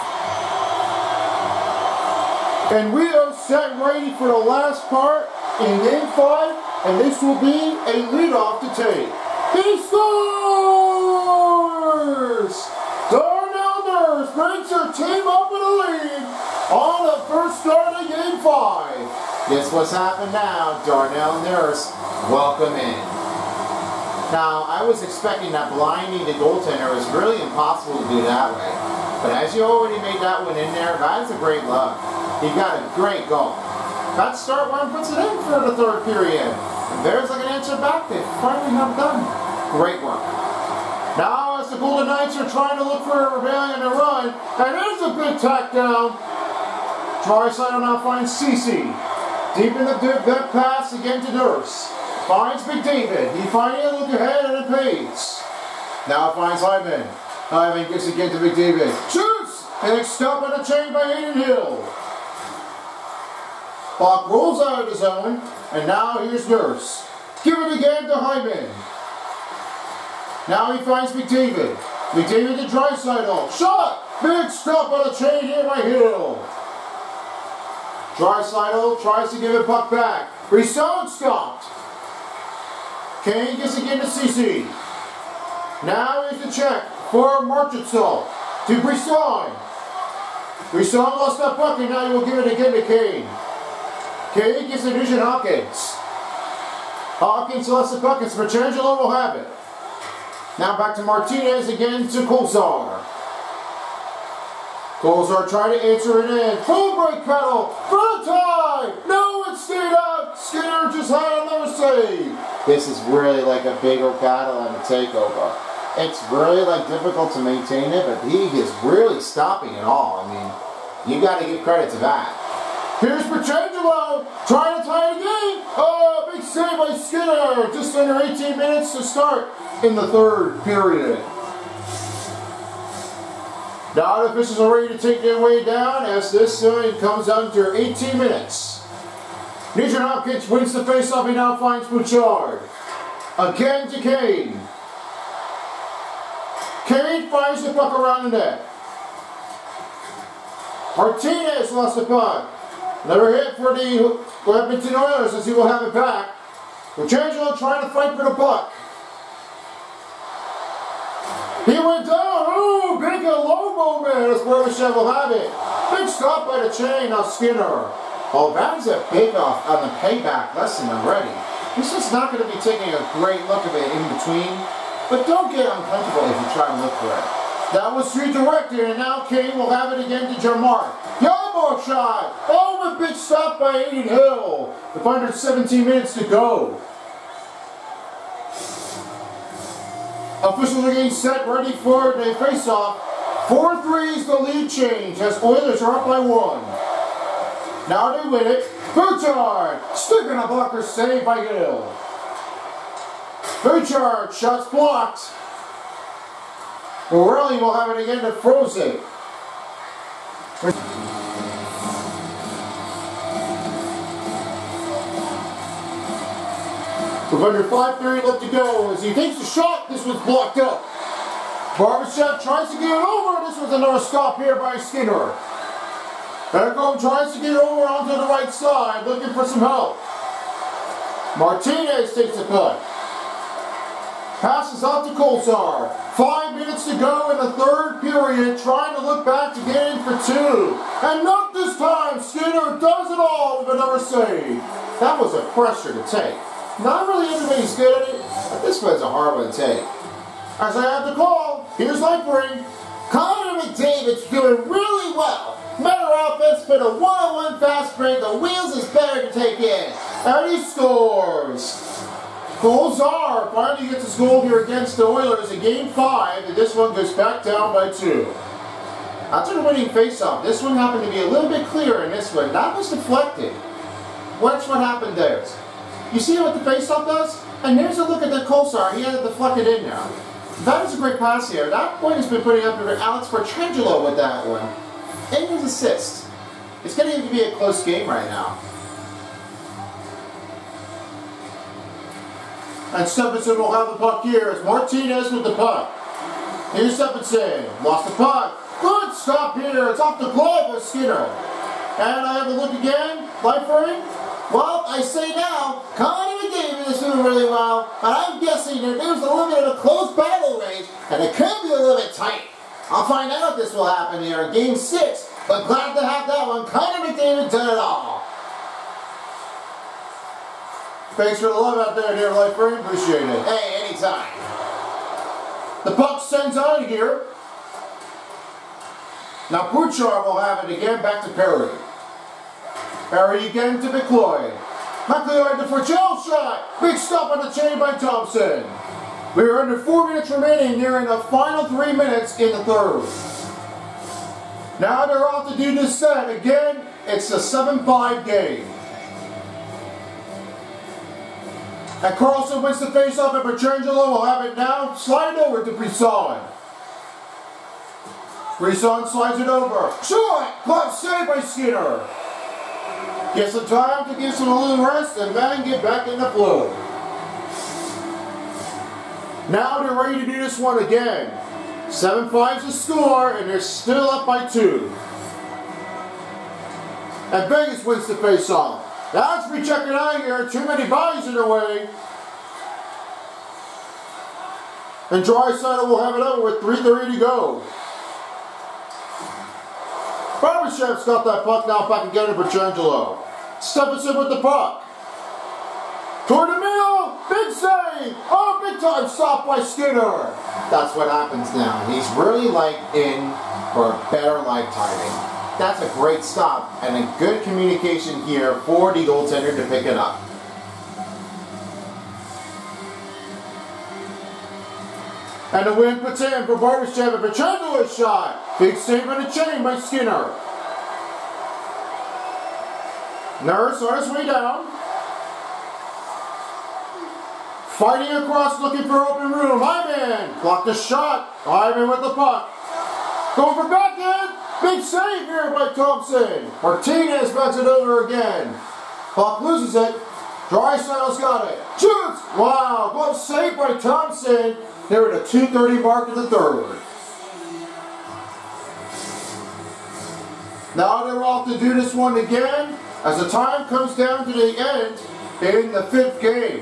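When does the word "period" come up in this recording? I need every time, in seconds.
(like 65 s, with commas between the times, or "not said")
36 s, 130 s, 238 s.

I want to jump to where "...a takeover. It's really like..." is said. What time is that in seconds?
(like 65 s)
114 s.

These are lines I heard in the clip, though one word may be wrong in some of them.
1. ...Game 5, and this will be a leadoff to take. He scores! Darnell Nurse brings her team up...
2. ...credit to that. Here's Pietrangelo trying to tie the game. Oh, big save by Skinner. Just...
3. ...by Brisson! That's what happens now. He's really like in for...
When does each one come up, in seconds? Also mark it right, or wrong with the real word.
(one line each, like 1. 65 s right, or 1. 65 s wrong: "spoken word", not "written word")
1. 5 s right
2. 121 s right
3. 399 s wrong: "Skinner", not "Brisson".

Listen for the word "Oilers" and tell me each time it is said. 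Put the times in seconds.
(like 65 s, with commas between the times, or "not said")
154 s, 195 s, 265 s.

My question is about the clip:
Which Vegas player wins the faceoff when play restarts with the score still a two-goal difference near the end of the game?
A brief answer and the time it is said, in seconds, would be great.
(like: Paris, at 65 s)
Karlsson, at 352 s.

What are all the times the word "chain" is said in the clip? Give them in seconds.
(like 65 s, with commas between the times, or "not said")
60 s, 75 s, 166 s, 337 s, 419 s.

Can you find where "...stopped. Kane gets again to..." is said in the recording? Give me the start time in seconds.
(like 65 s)
81 s.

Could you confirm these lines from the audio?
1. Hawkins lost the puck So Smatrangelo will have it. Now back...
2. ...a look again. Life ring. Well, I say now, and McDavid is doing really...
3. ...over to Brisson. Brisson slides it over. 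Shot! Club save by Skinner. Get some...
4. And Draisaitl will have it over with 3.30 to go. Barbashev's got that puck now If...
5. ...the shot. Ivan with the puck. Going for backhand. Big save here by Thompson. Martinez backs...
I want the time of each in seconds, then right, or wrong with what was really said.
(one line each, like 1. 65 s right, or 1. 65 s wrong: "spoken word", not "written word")
1. 97 s right
2. 302 s right
3. 355 s right
4. 385 s right
5. 430 s right.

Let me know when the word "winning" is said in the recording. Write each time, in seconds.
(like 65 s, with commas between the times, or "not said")
269 s.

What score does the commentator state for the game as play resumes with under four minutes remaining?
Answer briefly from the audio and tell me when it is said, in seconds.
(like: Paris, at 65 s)
7-5, at 347 s.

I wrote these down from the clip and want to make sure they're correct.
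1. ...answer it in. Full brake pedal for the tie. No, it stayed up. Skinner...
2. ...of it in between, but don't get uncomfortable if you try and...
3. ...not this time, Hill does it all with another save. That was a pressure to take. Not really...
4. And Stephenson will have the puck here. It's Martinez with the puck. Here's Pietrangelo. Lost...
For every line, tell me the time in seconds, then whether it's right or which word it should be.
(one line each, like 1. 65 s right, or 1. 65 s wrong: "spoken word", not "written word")
1. 105 s right
2. 173 s right
3. 241 s wrong: "Skinner", not "Hill"
4. 292 s wrong: "Stephenson", not "Pietrangelo".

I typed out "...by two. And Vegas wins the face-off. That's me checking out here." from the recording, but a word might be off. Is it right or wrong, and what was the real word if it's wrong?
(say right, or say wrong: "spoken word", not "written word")
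right.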